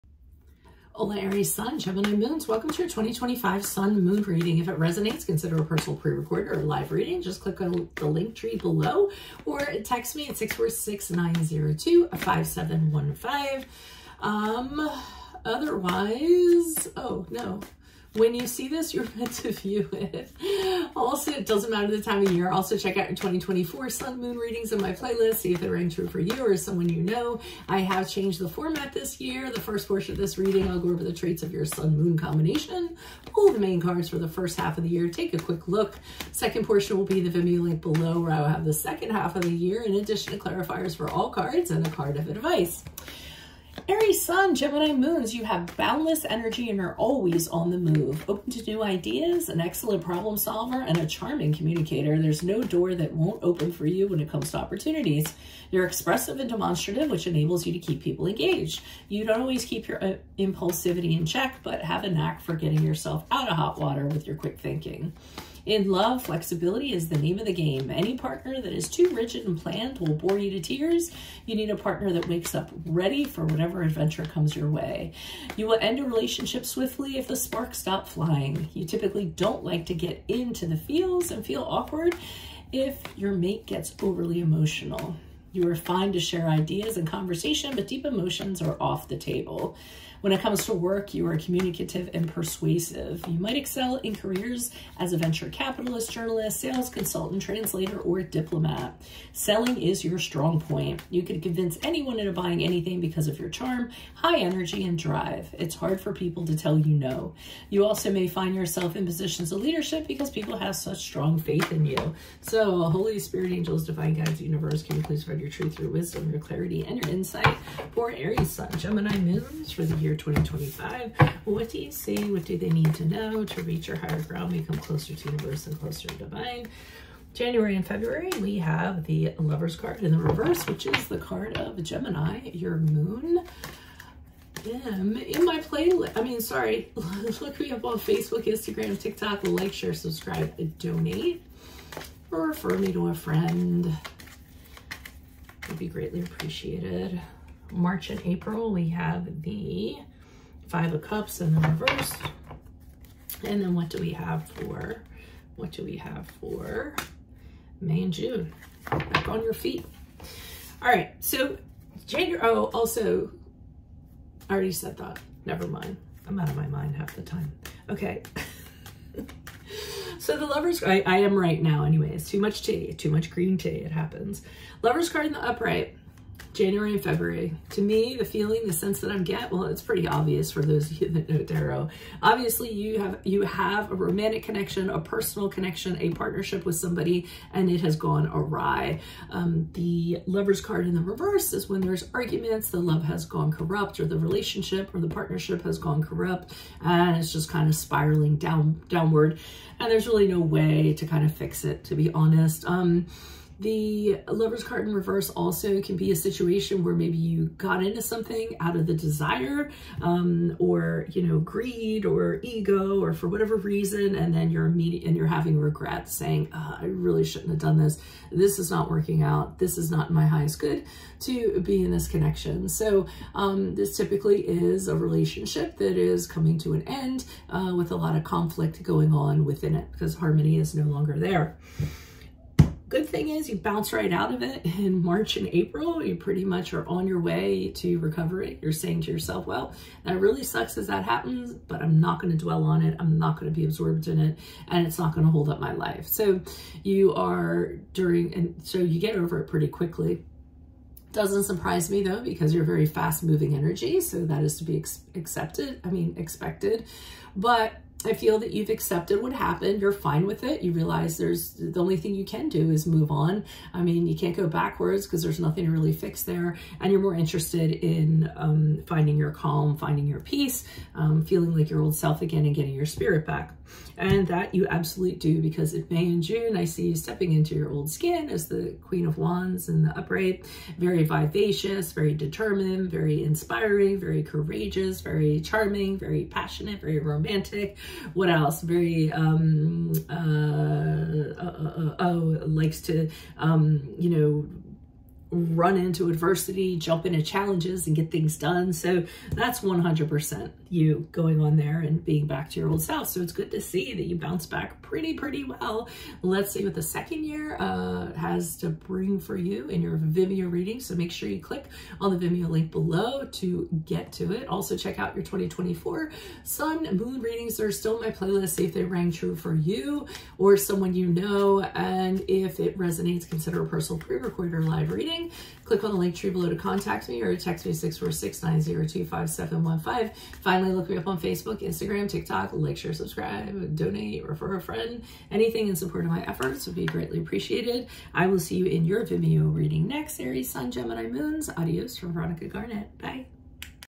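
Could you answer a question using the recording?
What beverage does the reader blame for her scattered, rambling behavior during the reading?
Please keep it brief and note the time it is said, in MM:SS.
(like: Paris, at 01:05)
green tea, at 02:53.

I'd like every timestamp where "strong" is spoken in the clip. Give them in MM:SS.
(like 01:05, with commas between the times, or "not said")
01:40, 01:50.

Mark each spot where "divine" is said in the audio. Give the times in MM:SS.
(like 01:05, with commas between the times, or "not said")
01:53, 02:06.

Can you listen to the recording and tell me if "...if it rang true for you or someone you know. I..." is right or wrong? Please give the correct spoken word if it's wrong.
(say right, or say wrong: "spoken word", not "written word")
right.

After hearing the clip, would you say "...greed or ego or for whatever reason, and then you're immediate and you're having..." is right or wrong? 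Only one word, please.
right.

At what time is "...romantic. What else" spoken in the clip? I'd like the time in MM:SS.
04:46.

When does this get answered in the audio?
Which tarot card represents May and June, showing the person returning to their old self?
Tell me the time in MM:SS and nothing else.
04:38.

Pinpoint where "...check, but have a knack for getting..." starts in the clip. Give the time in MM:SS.
01:01.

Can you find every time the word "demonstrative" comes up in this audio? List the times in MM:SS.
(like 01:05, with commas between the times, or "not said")
00:56.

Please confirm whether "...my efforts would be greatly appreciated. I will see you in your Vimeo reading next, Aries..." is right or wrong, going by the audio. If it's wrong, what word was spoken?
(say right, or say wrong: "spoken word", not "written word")
right.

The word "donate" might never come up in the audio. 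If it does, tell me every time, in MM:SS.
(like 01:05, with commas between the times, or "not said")
02:20, 05:33.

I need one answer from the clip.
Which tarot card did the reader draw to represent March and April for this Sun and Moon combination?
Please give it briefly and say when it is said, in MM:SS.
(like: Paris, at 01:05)
Five of Cups, at 02:30.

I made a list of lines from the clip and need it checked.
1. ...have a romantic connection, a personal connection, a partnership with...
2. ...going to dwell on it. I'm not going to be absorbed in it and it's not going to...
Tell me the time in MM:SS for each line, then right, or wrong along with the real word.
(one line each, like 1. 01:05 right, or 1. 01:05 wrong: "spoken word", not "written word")
1. 03:03 right
2. 04:02 right.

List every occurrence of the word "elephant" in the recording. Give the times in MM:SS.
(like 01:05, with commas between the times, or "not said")
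not said.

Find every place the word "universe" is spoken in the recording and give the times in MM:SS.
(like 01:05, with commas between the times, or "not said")
01:54, 02:05.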